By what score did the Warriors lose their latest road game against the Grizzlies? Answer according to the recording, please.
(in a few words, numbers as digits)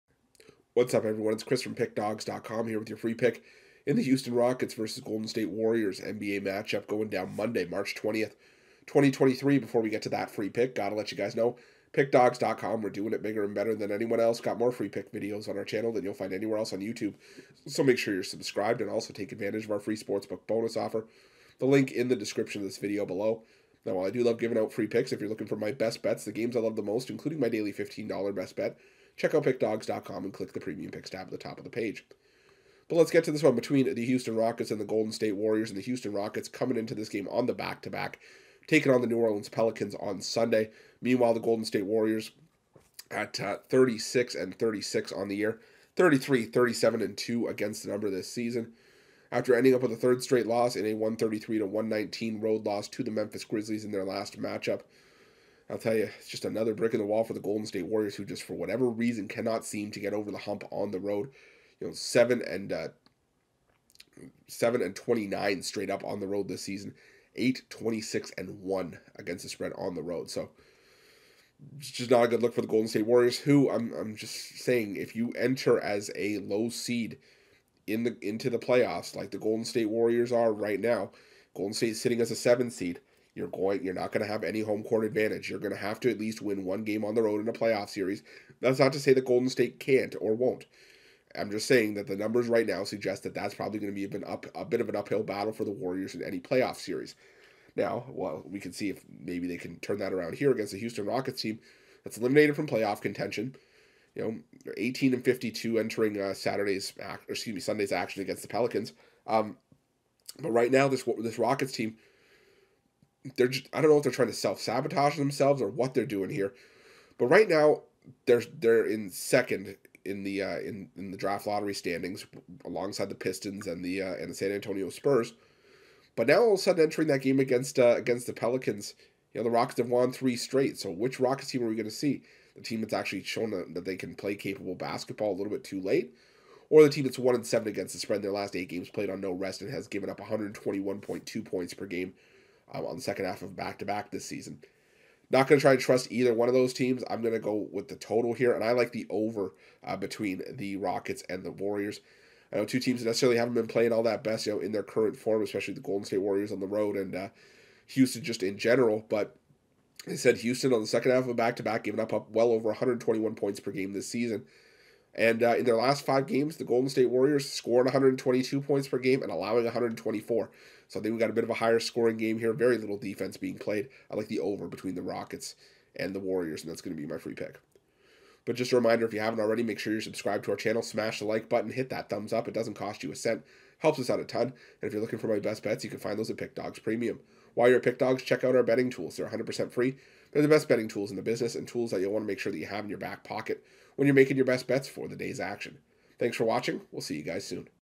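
133 to 119.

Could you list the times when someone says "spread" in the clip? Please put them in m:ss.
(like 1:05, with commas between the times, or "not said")
1:09, 2:17.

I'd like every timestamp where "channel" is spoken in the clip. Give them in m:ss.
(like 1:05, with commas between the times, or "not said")
0:15, 3:00.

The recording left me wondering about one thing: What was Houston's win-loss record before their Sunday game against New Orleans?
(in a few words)
18-52.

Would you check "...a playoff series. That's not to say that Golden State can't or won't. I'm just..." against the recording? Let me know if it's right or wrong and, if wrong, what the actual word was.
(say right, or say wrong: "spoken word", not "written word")
right.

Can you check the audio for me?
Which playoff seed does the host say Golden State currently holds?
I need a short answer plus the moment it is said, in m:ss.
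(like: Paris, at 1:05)
7, at 1:22.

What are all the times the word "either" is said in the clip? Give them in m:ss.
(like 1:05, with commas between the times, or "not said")
2:26.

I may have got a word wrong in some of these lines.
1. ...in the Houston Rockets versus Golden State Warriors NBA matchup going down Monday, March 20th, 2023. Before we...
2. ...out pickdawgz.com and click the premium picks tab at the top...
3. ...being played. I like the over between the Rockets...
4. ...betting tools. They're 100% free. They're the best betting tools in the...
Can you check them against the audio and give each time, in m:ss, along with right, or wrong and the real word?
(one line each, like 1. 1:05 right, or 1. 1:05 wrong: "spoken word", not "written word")
1. 0:03 right
2. 0:29 right
3. 2:53 right
4. 3:08 right.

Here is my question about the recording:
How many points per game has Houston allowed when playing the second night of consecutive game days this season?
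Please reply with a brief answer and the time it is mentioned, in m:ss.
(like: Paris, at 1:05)
121.2, at 2:20.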